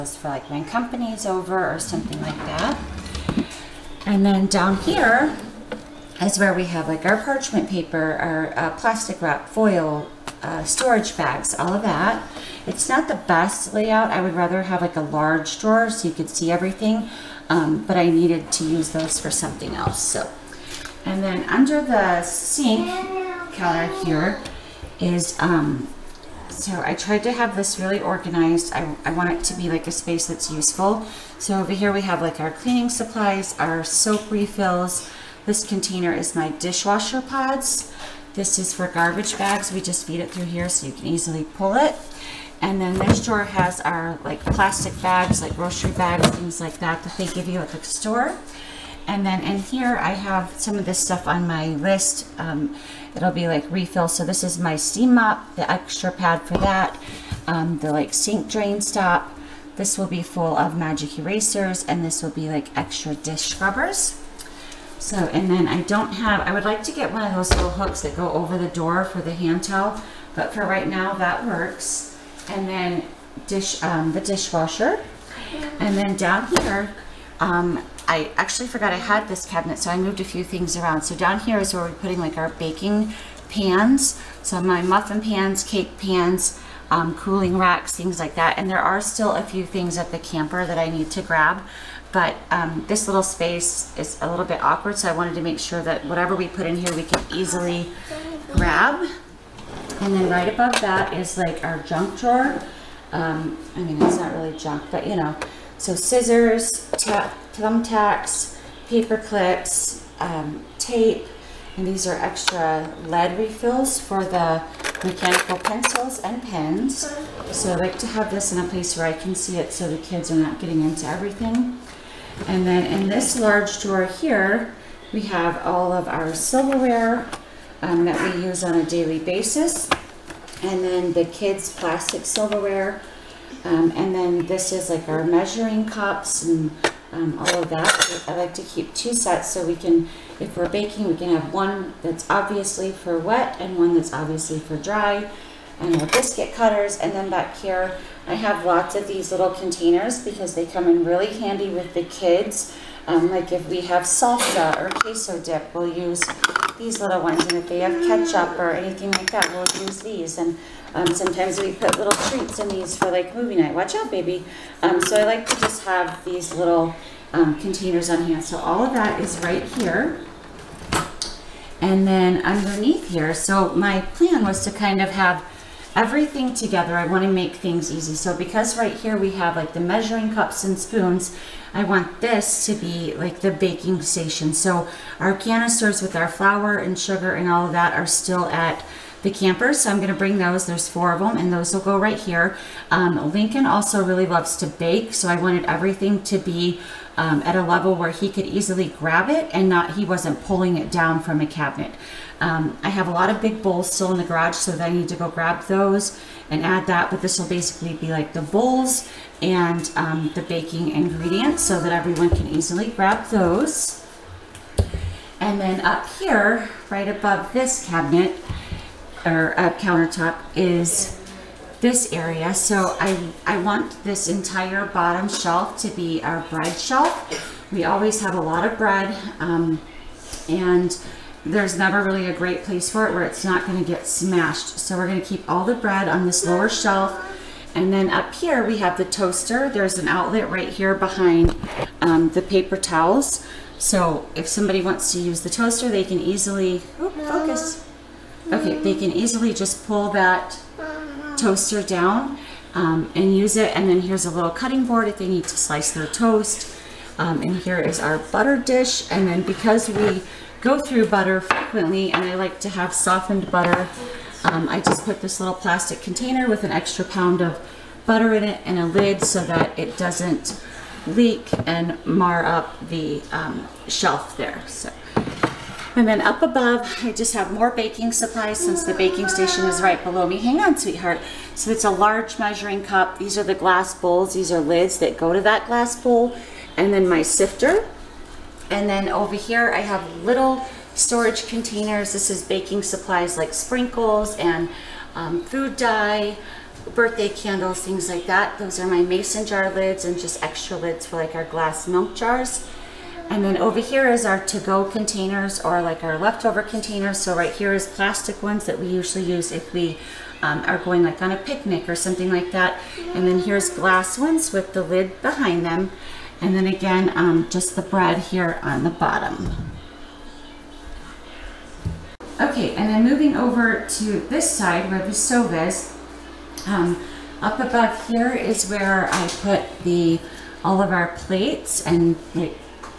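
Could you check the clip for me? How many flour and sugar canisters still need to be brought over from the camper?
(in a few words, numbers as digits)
4.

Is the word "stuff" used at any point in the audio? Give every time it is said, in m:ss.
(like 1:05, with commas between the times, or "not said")
0:50.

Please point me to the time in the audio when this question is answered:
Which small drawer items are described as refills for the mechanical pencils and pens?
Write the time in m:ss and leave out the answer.
1:52.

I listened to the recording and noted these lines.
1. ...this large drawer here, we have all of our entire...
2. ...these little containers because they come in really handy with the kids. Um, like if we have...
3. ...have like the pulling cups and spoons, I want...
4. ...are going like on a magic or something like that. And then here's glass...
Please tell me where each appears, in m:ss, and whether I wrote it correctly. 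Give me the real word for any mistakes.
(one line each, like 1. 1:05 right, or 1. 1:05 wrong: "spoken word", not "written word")
1. 2:03 wrong: "silverware", not "entire"
2. 2:29 right
3. 2:59 wrong: "measuring", not "pulling"
4. 5:10 wrong: "picnic", not "magic".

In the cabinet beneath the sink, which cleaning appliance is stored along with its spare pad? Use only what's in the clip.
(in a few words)
steam mop.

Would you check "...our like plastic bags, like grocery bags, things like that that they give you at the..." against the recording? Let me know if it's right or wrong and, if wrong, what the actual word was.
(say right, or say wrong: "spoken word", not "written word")
right.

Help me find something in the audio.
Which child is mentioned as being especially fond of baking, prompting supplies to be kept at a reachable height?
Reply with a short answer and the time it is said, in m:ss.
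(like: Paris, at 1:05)
Lincoln, at 3:13.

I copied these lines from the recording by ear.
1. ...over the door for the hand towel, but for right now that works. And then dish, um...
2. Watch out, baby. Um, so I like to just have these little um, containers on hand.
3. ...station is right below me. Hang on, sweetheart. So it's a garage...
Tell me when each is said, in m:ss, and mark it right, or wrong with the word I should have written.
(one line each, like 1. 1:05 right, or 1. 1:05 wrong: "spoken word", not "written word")
1. 1:08 right
2. 2:43 right
3. 4:39 wrong: "large", not "garage".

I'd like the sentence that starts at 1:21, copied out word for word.
So down here is where we're putting like our baking pans.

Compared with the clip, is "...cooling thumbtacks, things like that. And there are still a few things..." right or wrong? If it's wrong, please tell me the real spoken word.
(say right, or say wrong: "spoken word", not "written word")
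wrong: "racks", not "thumbtacks".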